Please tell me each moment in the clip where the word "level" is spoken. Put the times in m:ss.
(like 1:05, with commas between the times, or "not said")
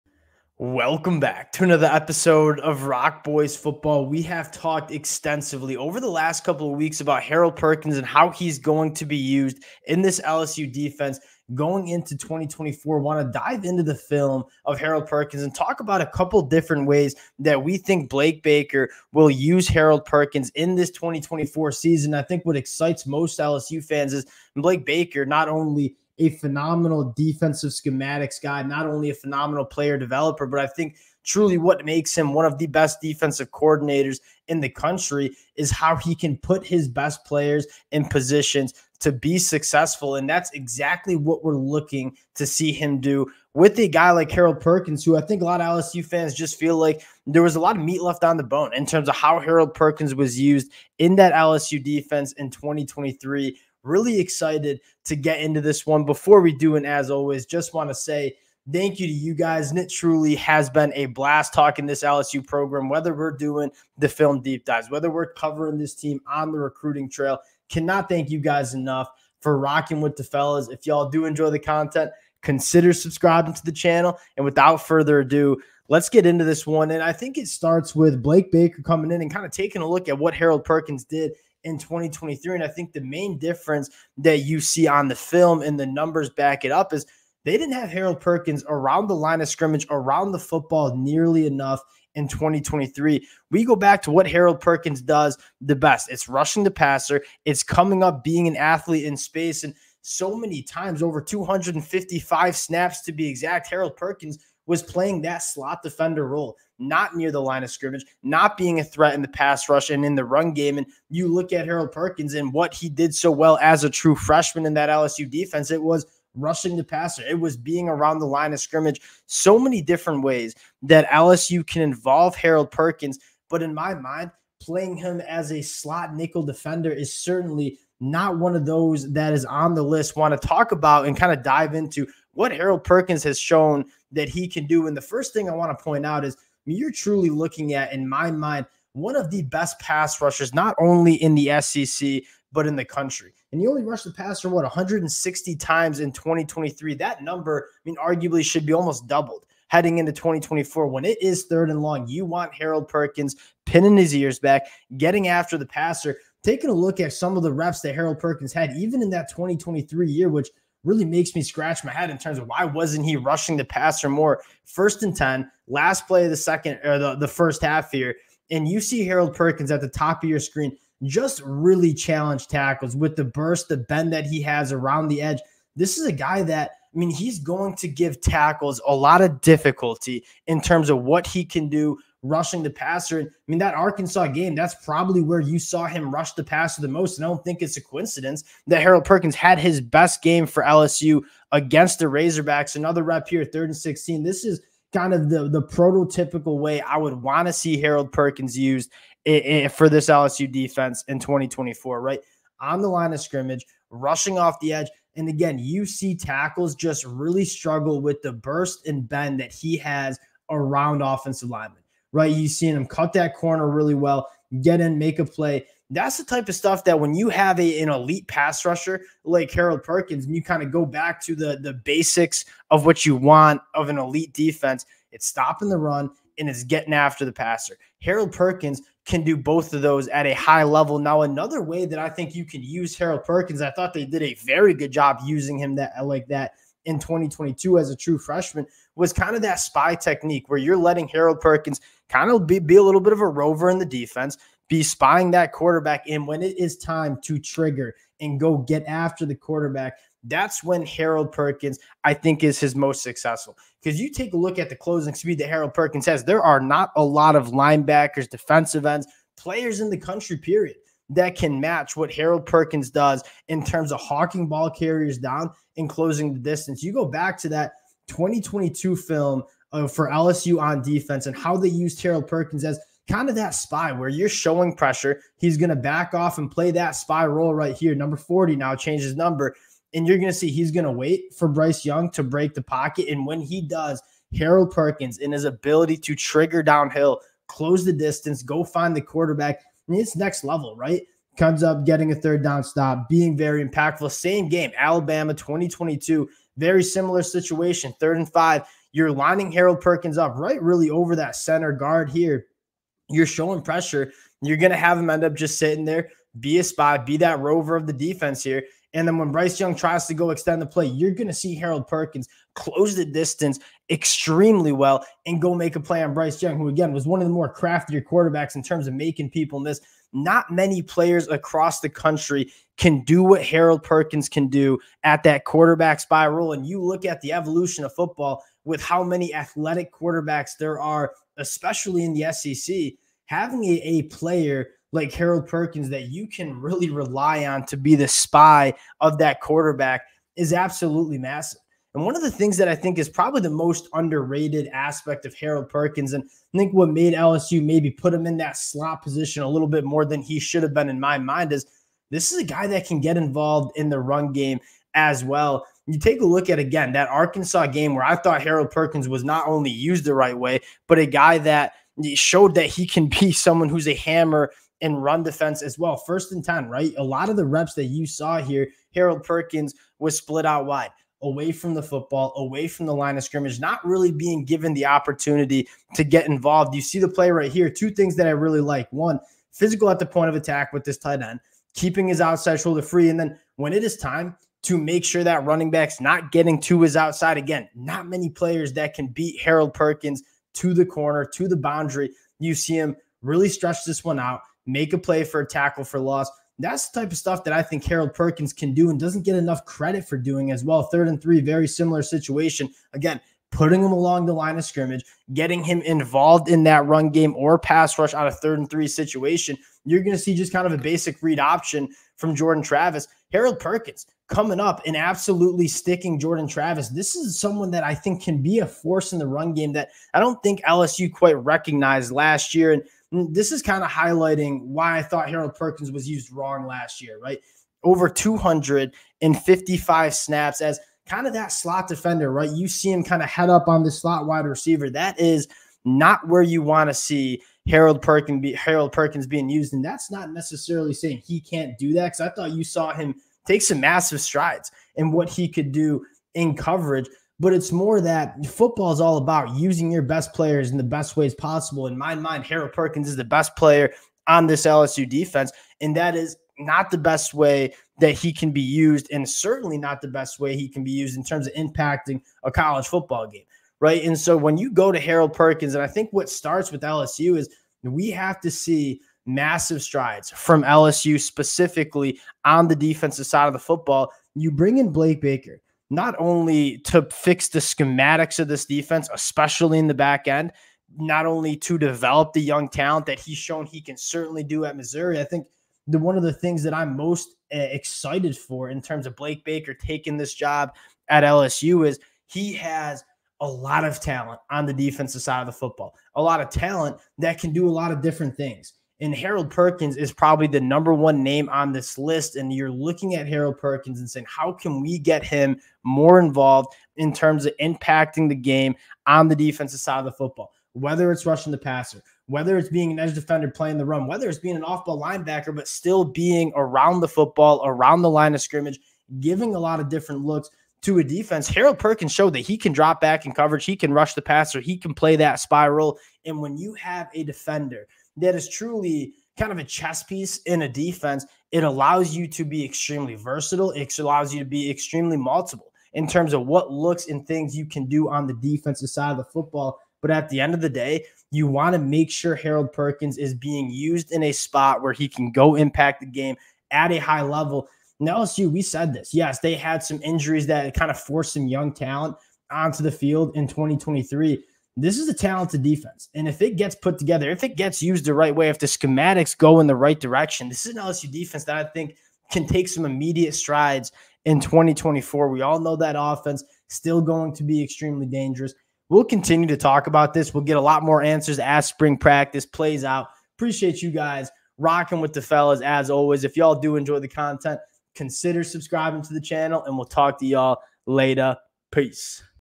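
3:50, 4:50, 9:07.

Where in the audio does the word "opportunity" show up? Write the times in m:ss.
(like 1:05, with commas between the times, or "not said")
6:14.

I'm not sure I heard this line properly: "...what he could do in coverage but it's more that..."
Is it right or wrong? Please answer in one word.
right.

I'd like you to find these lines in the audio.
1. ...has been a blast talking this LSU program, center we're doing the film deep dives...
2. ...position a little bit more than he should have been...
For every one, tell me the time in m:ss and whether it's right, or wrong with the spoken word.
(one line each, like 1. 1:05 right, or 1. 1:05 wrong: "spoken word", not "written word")
1. 1:00 wrong: "whether", not "center"
2. 5:49 right.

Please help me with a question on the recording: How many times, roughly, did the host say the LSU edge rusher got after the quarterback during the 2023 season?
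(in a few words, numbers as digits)
160.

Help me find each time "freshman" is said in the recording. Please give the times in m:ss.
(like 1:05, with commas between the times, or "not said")
1:54, 3:58.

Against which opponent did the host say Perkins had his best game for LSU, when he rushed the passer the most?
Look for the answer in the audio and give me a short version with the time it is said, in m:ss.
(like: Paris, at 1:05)
Razorbacks, at 3:12.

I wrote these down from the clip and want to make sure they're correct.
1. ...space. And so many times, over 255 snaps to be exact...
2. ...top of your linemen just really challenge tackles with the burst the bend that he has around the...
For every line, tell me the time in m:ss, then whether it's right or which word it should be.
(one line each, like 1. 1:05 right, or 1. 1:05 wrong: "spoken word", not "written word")
1. 1:39 right
2. 2:49 wrong: "screen", not "linemen".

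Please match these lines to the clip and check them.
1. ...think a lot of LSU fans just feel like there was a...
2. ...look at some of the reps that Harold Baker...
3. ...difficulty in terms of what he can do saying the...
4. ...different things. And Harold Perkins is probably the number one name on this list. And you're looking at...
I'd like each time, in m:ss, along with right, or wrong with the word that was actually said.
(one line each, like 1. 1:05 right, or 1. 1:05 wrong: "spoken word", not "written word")
1. 0:45 right
2. 2:36 wrong: "Perkins", not "Baker"
3. 2:59 wrong: "rushing", not "saying"
4. 8:18 right.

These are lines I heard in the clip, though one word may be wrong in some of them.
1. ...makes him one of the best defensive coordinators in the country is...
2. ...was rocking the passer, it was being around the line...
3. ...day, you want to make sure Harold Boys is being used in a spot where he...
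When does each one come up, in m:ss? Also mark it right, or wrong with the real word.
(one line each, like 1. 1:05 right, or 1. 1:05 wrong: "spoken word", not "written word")
1. 0:31 right
2. 1:55 wrong: "rushing", not "rocking"
3. 9:00 wrong: "Perkins", not "Boys".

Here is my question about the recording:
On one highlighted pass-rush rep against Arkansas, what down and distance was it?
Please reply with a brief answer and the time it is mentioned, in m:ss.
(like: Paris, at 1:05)
Third and 16, at 3:13.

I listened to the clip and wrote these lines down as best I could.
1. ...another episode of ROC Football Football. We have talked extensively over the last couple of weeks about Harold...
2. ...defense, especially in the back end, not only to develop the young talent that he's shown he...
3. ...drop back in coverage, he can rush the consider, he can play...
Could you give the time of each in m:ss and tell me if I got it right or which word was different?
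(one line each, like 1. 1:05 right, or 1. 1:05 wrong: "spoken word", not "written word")
1. 0:01 wrong: "Boys", not "Football"
2. 7:58 right
3. 8:42 wrong: "passer", not "consider".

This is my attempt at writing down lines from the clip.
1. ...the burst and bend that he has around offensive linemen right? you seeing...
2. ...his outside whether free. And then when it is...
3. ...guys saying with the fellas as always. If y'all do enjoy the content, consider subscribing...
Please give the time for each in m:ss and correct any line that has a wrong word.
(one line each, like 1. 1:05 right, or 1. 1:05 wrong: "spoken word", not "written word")
1. 3:28 right
2. 6:22 wrong: "shoulder", not "whether"
3. 9:33 wrong: "rocking", not "saying".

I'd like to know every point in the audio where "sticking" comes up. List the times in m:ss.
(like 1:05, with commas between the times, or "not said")
6:55.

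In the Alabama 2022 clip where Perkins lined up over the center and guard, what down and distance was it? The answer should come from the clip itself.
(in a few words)
Third and five.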